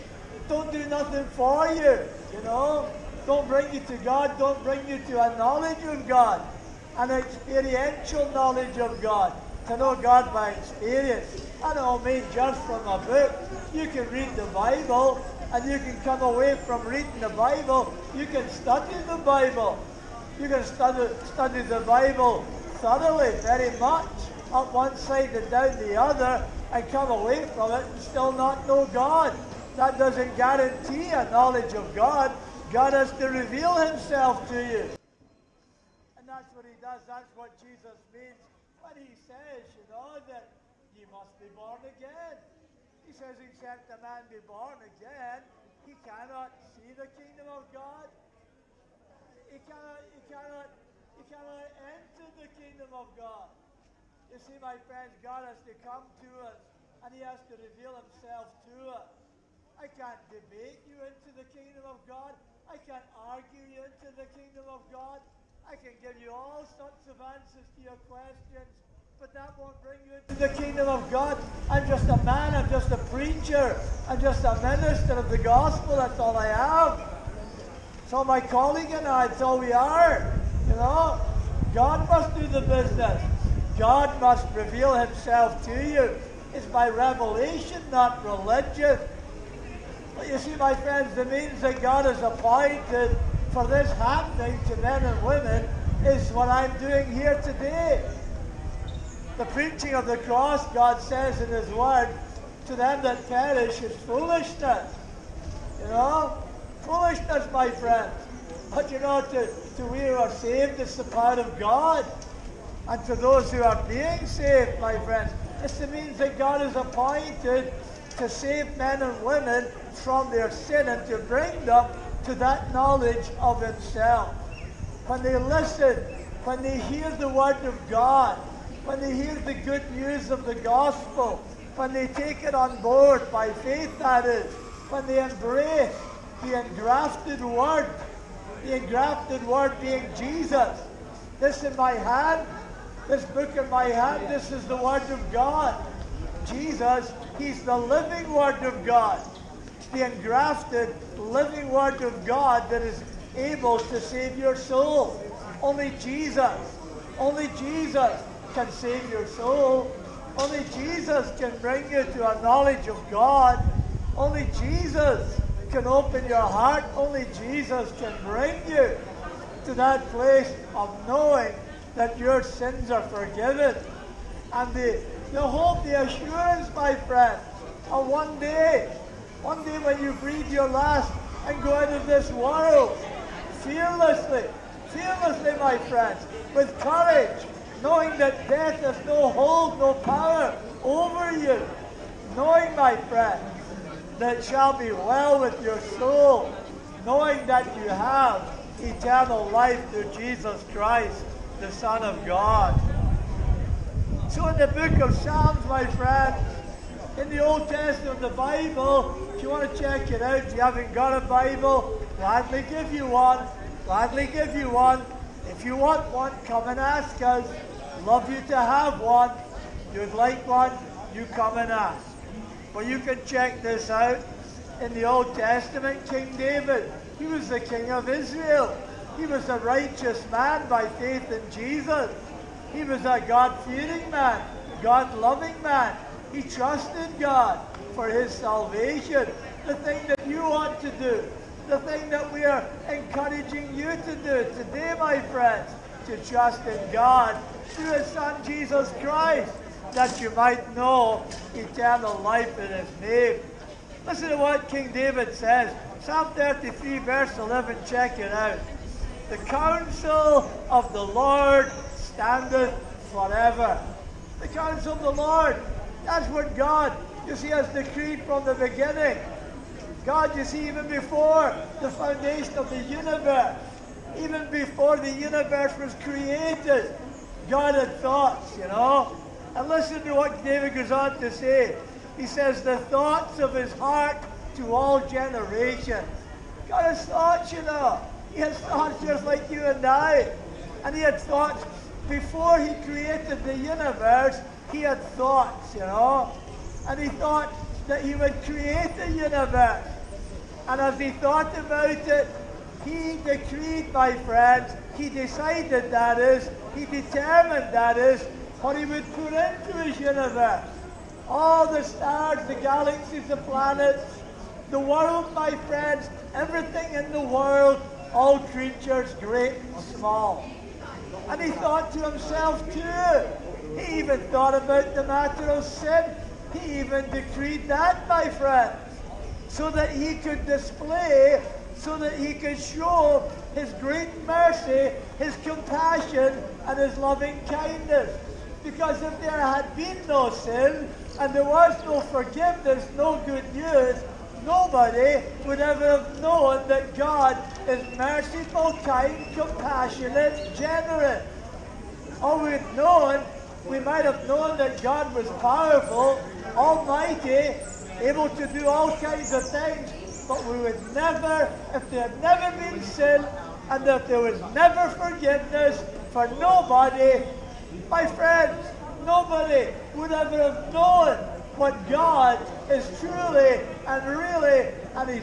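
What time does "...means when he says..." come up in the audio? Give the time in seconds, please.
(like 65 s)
38 s.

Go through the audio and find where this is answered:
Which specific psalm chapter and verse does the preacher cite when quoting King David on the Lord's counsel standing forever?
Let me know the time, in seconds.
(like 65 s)
255 s.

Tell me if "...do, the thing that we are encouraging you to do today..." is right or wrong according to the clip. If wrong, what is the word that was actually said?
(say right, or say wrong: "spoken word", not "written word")
right.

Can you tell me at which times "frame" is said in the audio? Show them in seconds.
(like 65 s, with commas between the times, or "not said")
not said.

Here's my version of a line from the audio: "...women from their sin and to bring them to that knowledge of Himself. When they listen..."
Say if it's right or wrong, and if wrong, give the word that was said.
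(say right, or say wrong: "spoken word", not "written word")
right.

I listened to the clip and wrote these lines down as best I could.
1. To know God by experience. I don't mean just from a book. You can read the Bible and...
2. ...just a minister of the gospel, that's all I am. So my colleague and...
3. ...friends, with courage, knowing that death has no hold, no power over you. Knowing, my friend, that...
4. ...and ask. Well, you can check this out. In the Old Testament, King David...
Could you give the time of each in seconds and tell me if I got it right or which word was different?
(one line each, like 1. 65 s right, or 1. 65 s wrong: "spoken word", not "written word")
1. 9 s right
2. 74 s right
3. 185 s right
4. 221 s right.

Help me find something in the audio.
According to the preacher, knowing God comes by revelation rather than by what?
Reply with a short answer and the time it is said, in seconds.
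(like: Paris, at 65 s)
Religion, at 88 s.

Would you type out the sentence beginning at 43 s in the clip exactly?
He says, except a man be born again, he cannot see the kingdom of God.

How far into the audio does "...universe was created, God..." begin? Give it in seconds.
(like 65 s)
275 s.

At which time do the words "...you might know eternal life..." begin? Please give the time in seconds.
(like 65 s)
250 s.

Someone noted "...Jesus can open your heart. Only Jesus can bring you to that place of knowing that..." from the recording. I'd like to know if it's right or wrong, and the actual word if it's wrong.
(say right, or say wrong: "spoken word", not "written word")
right.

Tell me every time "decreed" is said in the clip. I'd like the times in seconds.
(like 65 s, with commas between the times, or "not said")
267 s, 303 s, 327 s.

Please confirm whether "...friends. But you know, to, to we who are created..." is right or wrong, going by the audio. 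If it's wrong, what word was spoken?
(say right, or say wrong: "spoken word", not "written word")
wrong: "saved", not "created".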